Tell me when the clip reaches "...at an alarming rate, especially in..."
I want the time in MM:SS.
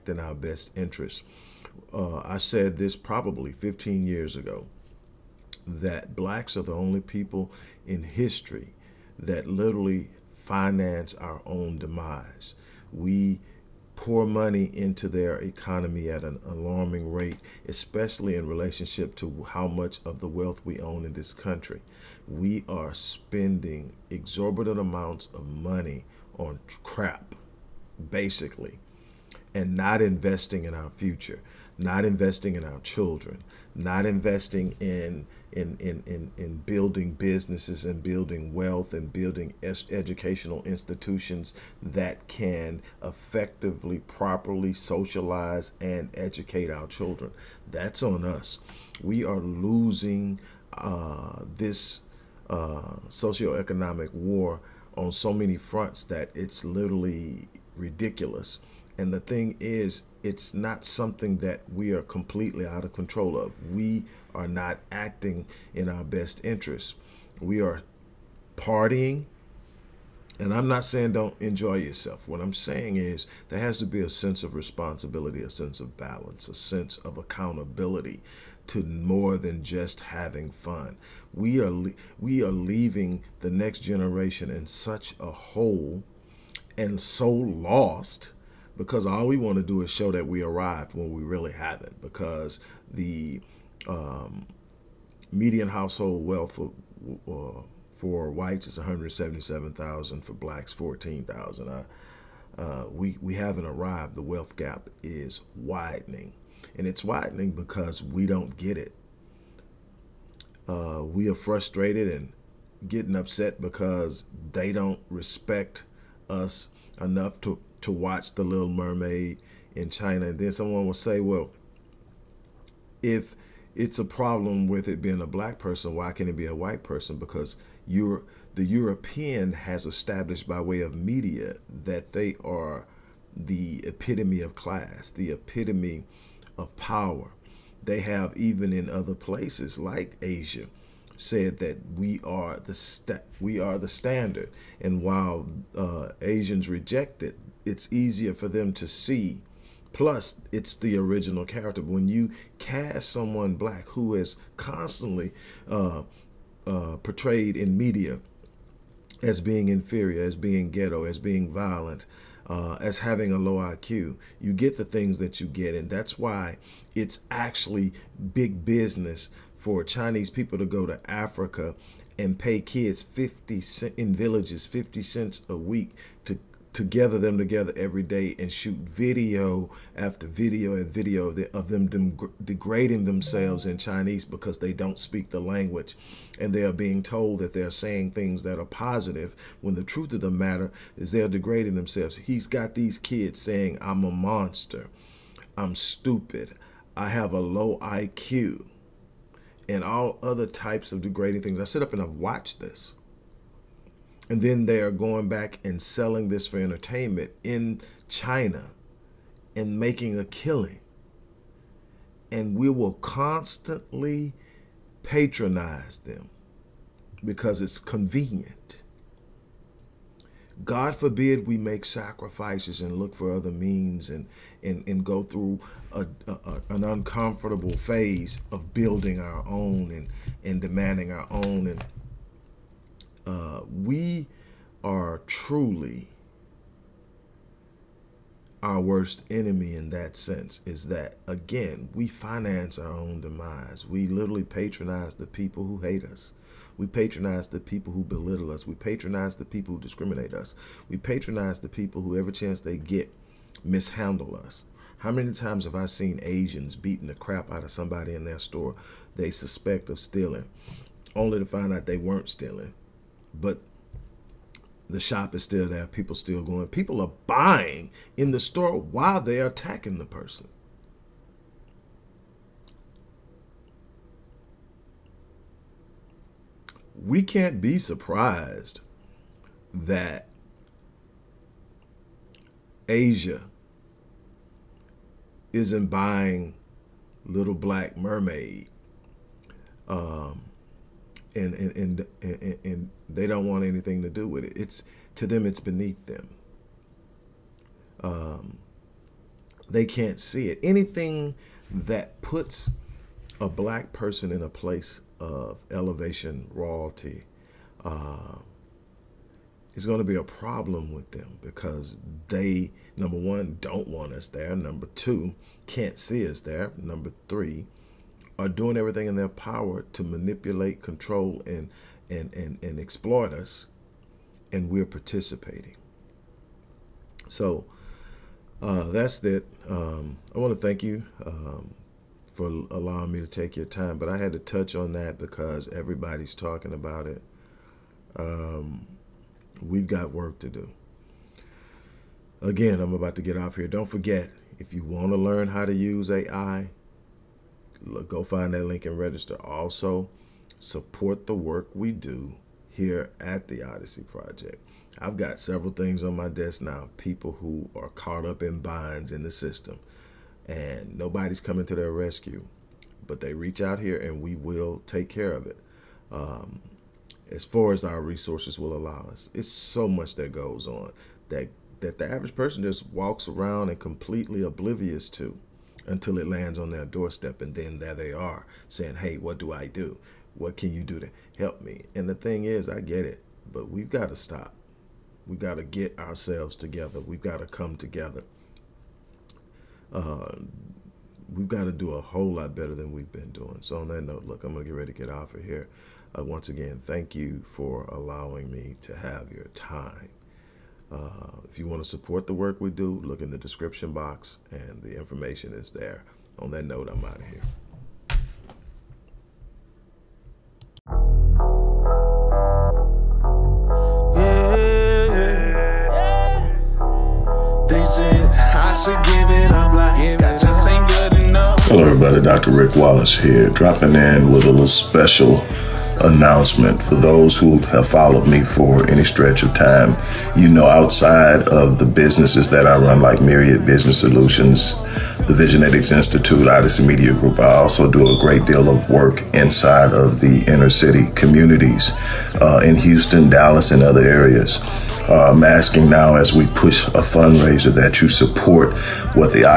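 00:16.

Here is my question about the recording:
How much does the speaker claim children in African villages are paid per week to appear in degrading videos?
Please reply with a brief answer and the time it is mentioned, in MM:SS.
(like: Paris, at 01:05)
50 cents, at 02:54.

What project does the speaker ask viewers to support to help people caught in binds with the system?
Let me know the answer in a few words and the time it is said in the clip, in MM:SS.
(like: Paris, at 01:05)
Odyssey Project, at 05:53.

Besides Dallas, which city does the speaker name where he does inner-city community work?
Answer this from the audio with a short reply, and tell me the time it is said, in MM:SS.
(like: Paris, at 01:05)
Houston, at 07:22.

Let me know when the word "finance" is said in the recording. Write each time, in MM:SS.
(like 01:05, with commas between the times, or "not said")
00:10, 04:02.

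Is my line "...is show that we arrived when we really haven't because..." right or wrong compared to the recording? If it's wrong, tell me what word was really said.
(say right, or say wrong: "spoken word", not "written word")
right.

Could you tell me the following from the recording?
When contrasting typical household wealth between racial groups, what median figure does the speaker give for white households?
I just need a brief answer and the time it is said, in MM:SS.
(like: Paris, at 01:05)
177,000, at 01:38.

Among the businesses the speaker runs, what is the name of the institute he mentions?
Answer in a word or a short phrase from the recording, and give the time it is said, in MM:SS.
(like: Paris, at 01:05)
Visionetics Institute, at 07:15.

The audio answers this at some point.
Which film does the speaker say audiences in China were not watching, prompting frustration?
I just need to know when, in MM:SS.
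01:58.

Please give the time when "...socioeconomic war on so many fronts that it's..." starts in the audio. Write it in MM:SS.
00:53.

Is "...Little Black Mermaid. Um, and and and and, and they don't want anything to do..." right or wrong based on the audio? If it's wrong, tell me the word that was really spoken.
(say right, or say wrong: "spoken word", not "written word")
right.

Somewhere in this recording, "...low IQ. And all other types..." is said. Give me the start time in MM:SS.
03:17.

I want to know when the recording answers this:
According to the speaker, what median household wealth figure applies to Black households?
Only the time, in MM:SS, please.
01:40.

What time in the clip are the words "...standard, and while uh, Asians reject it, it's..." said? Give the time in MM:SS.
02:23.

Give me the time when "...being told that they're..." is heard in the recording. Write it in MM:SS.
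03:06.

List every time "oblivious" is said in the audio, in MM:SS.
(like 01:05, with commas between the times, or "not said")
06:14.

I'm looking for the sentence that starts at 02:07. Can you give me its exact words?
Because you're the European has established by way of media that they are the epitome of class, the epitome of power.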